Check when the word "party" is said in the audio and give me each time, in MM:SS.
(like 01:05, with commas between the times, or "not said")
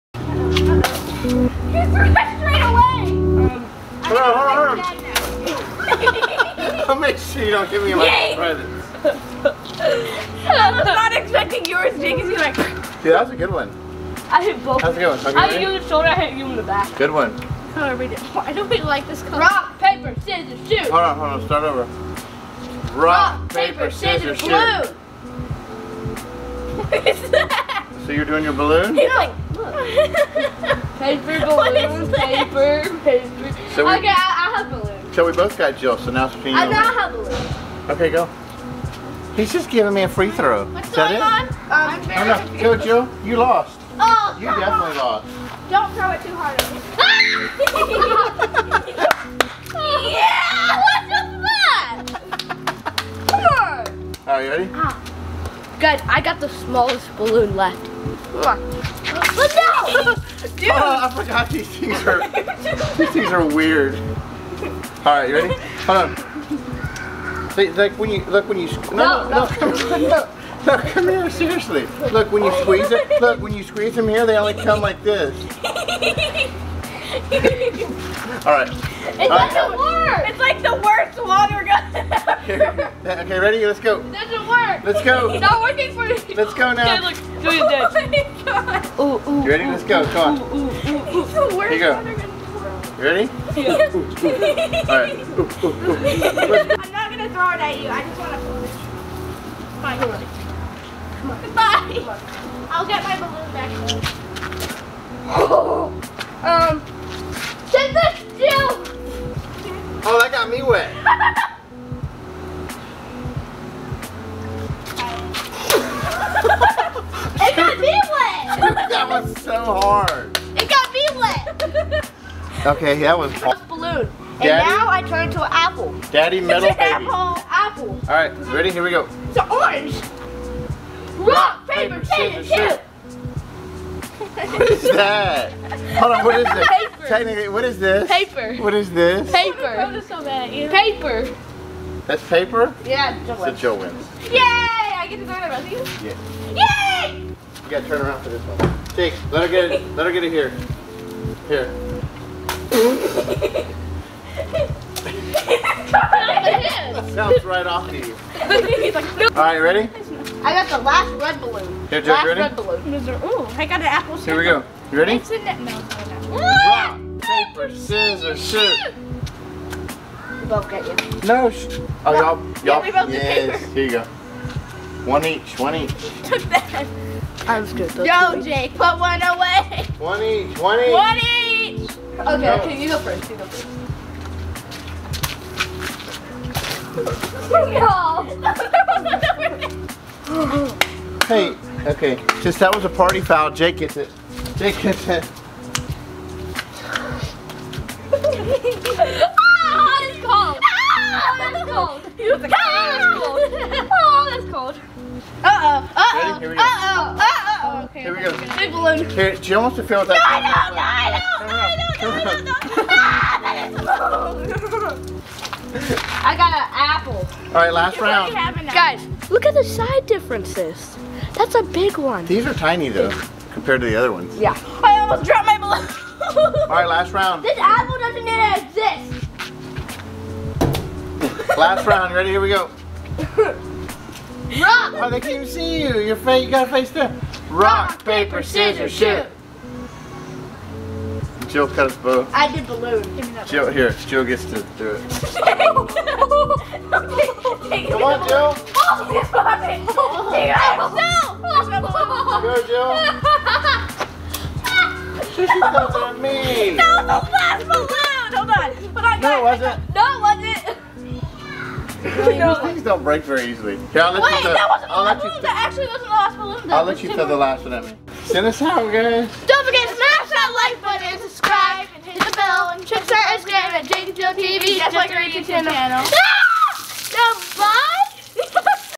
03:12.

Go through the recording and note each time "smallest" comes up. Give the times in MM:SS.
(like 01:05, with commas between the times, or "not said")
00:56.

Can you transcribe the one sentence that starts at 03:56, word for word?
Your face, you gotta face them.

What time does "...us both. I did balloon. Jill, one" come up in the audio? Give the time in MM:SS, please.
04:01.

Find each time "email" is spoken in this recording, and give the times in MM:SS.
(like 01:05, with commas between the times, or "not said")
not said.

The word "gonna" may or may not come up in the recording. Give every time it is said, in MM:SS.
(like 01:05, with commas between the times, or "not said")
01:37.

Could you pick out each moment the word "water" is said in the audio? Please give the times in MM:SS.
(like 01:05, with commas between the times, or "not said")
01:21, 01:31.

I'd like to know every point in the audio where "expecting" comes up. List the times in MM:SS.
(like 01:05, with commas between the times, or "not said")
00:11.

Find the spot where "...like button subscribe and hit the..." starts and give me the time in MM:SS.
04:30.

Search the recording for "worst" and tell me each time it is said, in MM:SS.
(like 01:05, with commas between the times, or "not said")
01:20, 01:31.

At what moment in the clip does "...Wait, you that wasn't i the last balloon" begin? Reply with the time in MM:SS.
04:24.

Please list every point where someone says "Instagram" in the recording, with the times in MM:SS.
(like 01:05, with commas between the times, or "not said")
04:33.